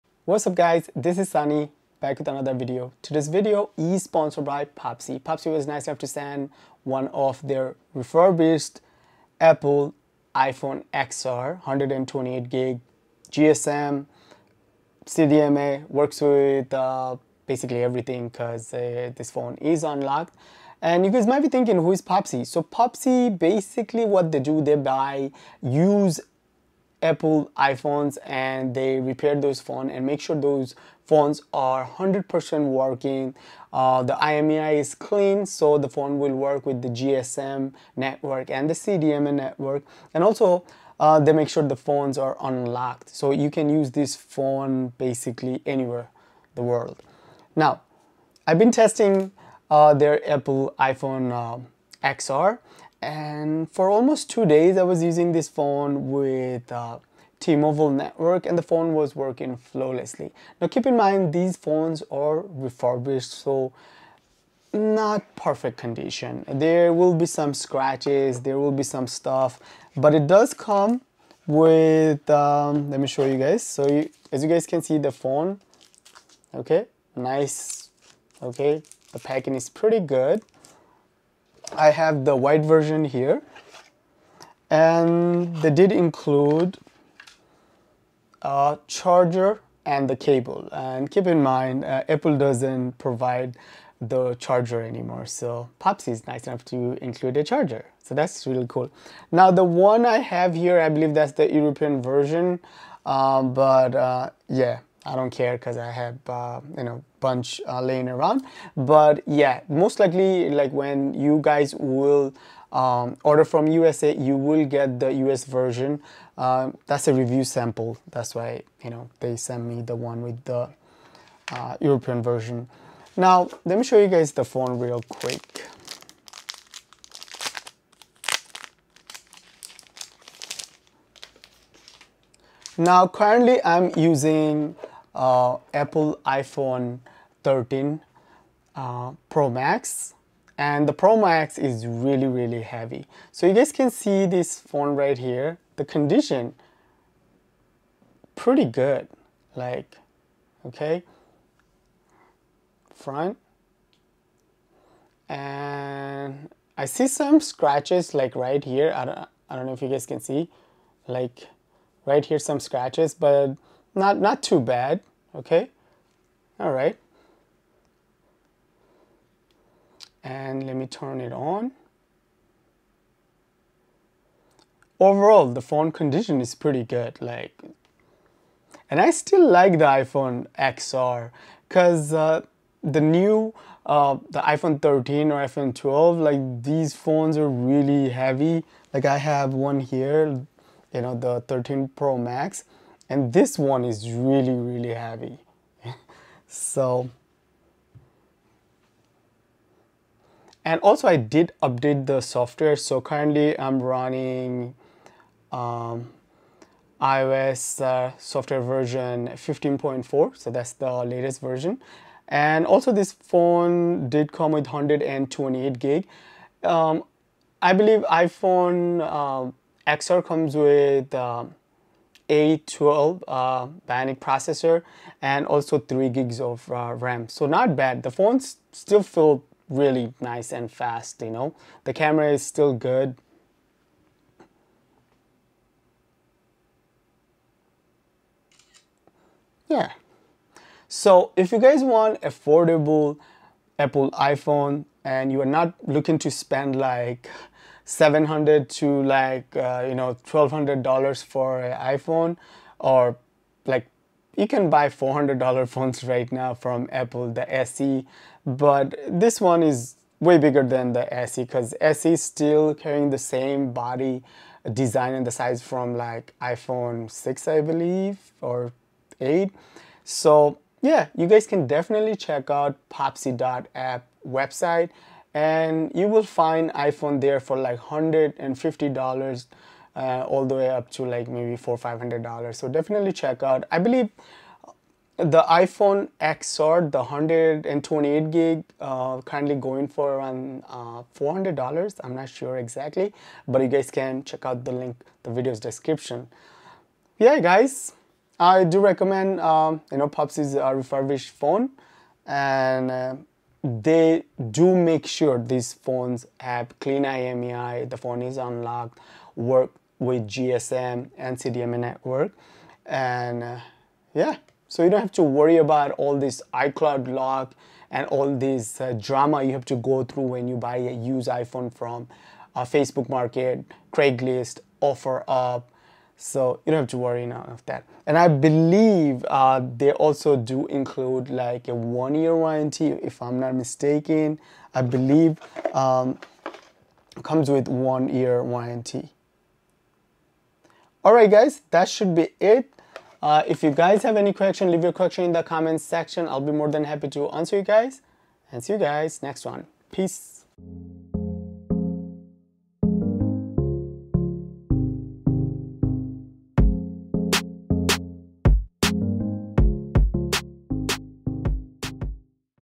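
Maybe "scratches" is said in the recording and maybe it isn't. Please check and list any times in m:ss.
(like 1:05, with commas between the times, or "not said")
1:07, 2:37, 2:42.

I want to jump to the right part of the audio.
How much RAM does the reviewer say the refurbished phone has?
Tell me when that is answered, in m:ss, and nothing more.
3:45.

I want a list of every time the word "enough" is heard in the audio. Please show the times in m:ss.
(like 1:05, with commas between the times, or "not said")
0:05, 1:36.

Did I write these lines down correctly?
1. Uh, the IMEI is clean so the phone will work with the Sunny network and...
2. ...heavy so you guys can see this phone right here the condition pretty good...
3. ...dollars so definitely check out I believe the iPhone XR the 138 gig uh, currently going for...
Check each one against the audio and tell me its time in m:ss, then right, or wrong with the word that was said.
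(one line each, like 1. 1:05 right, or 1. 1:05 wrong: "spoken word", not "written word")
1. 0:33 wrong: "GSM", not "Sunny"
2. 2:22 right
3. 4:42 wrong: "128", not "138".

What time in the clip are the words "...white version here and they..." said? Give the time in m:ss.
1:22.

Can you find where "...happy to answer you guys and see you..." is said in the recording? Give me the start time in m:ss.
5:46.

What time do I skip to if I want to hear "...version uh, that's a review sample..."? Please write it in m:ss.
1:55.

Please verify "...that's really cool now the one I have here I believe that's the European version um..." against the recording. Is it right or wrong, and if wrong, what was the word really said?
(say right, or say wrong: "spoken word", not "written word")
right.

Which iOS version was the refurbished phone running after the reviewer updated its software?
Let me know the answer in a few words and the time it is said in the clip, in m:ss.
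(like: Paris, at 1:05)
15.4, at 3:29.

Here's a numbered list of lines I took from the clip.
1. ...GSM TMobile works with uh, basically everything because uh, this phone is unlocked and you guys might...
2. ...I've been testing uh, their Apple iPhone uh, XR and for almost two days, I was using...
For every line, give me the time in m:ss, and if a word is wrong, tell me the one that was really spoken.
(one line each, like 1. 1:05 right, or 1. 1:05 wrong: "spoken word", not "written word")
1. 0:13 wrong: "CDMA", not "TMobile"
2. 0:48 right.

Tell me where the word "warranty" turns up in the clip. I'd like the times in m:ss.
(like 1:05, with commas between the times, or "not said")
5:32, 5:38.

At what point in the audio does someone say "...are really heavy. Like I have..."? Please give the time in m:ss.
3:07.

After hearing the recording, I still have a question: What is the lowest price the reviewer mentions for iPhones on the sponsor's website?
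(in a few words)
$150.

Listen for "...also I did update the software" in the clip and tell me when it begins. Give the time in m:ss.
3:20.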